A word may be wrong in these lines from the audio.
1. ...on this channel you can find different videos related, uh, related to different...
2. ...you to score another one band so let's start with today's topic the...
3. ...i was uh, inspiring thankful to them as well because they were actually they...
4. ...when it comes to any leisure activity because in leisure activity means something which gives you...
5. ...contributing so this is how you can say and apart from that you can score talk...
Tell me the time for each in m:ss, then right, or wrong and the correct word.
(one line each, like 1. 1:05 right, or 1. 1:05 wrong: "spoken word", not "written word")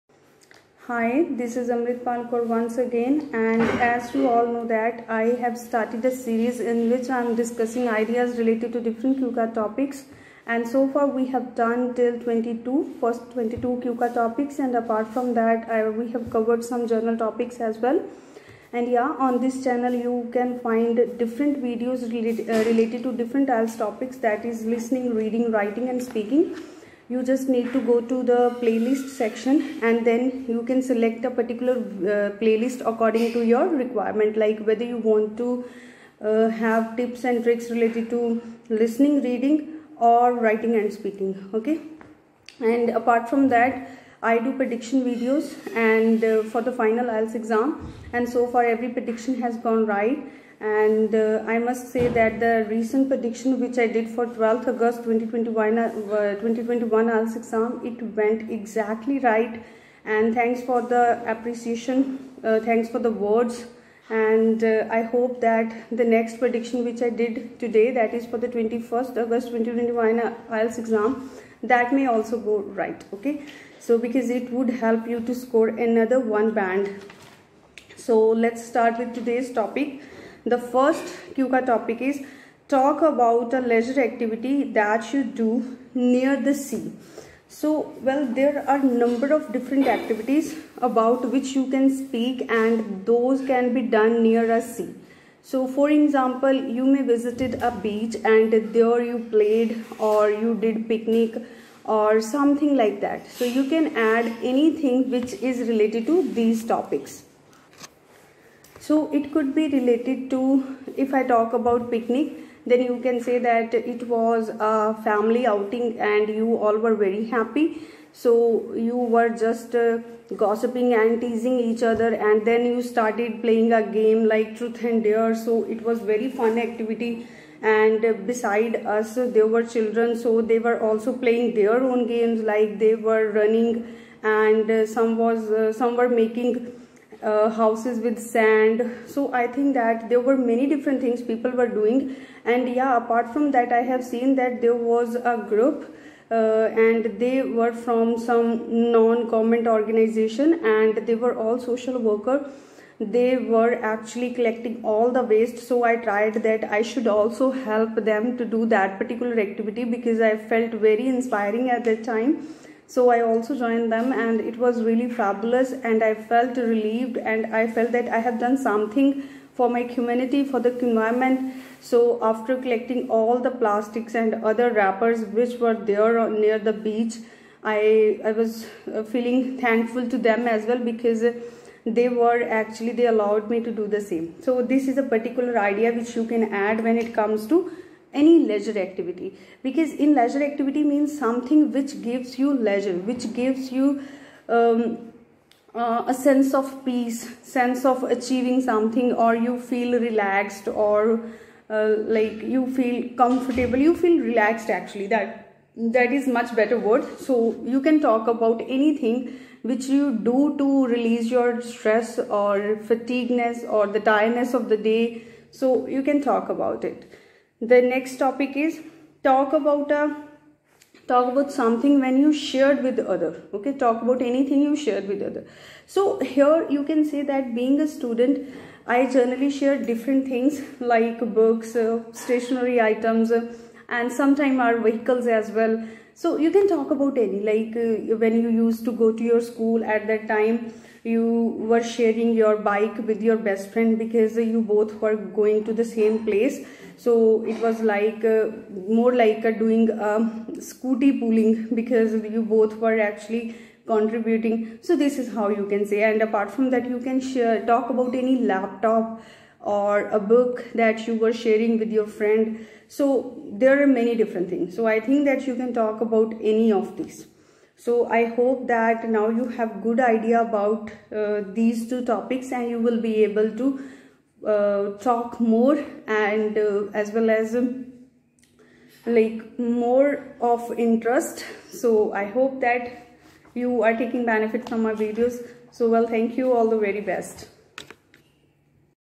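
1. 0:19 right
2. 1:15 right
3. 2:58 wrong: "feeling", not "inspiring"
4. 3:06 right
5. 4:13 wrong: "share", not "score".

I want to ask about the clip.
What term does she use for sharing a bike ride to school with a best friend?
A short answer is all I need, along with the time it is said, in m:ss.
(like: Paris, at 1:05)
Scooty pooling, at 4:10.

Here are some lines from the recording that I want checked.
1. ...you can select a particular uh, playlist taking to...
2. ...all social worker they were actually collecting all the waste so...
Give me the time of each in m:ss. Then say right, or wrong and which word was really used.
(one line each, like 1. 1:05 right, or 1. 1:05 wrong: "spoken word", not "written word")
1. 0:30 wrong: "according", not "taking"
2. 2:31 right.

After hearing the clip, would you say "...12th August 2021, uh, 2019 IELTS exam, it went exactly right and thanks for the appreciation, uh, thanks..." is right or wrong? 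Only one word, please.
wrong.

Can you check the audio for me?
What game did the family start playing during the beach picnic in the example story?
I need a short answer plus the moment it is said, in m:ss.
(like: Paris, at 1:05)
Truth and dare, at 2:04.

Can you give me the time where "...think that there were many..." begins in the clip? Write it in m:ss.
2:19.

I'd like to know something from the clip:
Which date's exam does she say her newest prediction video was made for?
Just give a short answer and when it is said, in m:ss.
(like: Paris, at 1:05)
21st August 2021, at 1:08.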